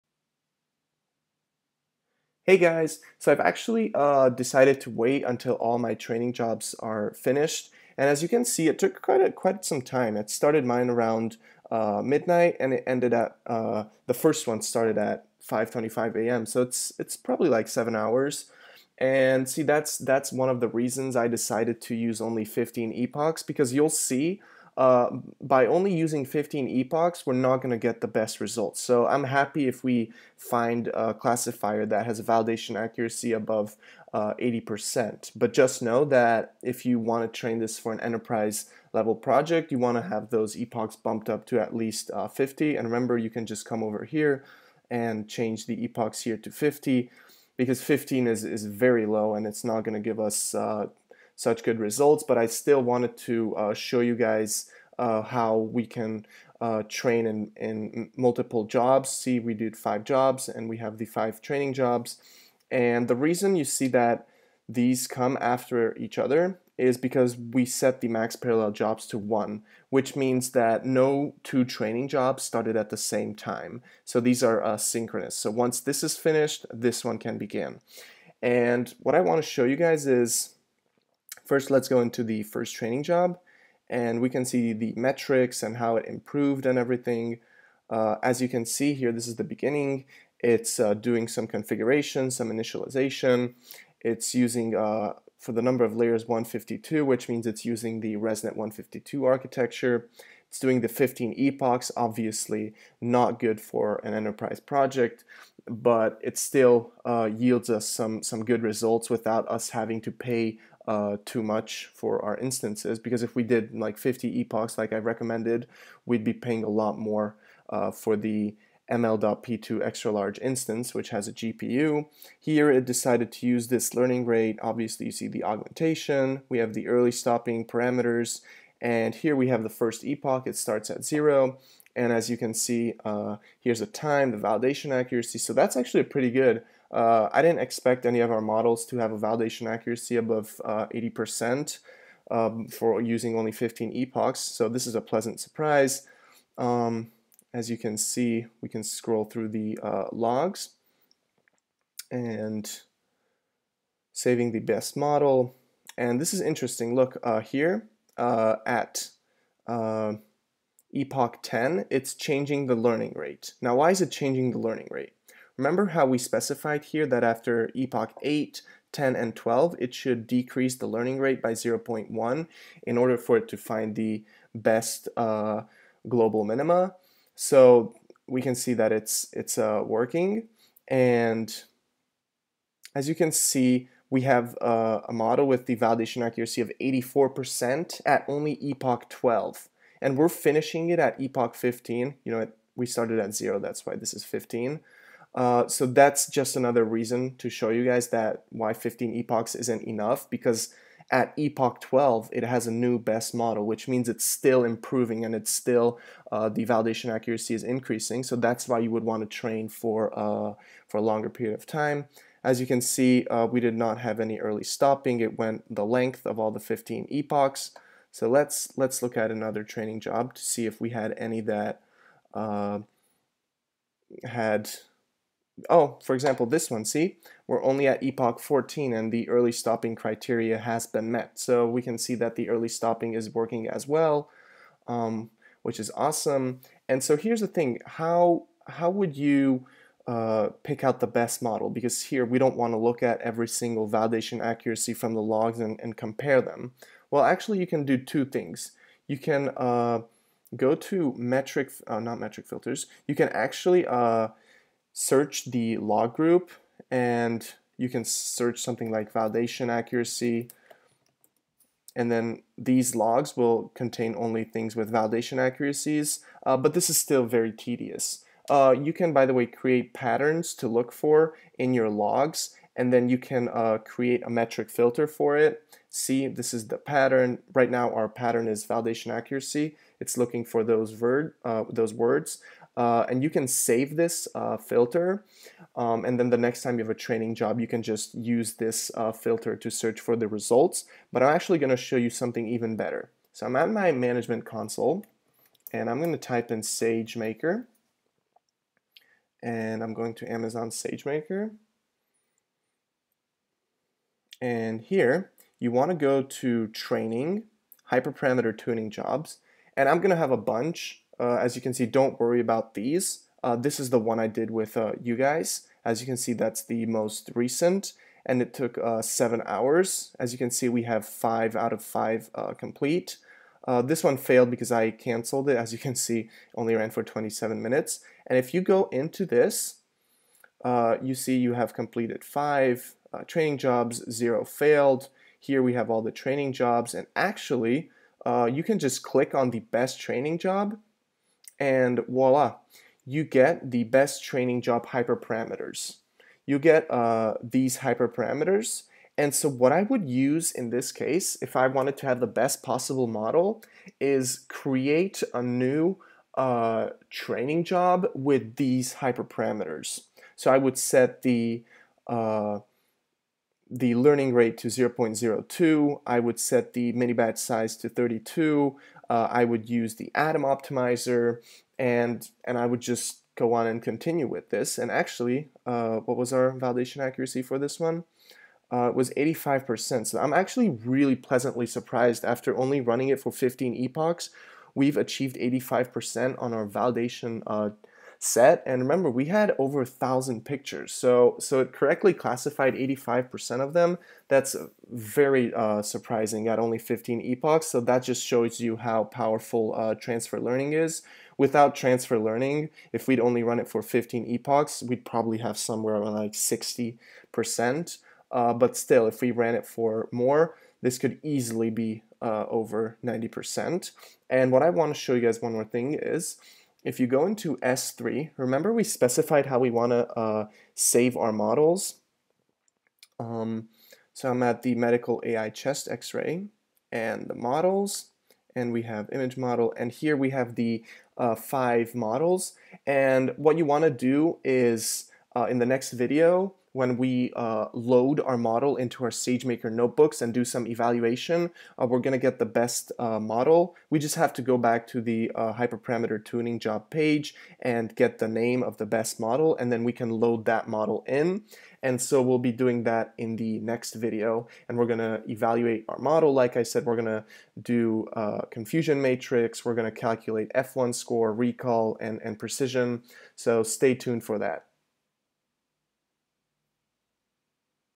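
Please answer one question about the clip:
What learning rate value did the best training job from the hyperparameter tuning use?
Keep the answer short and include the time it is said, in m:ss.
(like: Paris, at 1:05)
0.02, at 6:04.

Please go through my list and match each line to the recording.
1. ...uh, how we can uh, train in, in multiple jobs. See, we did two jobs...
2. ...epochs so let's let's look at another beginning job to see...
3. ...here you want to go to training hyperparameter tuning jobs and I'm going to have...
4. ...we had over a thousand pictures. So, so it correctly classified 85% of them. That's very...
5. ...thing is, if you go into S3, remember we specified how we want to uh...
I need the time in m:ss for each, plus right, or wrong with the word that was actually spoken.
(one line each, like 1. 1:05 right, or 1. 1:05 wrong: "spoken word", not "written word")
1. 0:54 wrong: "five", not "two"
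2. 3:37 wrong: "training", not "beginning"
3. 5:04 right
4. 6:29 right
5. 6:55 right.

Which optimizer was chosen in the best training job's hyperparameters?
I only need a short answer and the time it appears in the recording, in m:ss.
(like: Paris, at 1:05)
Adam, at 6:10.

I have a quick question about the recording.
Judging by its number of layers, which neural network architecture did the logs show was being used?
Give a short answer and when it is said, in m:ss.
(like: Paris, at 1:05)
ResNet 152, at 1:38.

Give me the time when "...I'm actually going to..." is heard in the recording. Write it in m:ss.
4:51.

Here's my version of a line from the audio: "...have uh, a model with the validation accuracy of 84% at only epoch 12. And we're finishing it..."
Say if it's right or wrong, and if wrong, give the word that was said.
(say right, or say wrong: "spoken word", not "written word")
right.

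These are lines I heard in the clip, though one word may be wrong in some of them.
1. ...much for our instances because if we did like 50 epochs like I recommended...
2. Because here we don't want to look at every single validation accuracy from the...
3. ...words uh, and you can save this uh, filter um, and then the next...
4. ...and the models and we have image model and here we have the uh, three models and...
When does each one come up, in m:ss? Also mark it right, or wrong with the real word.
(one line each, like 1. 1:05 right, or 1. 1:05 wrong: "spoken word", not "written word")
1. 1:51 right
2. 4:01 right
3. 4:41 right
4. 7:06 wrong: "five", not "three".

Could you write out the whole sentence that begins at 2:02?
Here it decided to use this learning rate.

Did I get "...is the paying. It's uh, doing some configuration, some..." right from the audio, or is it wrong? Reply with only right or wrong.
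wrong.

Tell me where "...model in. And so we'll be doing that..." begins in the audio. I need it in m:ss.
7:30.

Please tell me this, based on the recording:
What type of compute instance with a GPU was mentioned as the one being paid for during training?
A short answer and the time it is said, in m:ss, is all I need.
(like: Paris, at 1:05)
ml.p2 extra large, at 1:58.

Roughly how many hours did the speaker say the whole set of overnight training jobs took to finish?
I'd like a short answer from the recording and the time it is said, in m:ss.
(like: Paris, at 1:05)
7 hours, at 0:17.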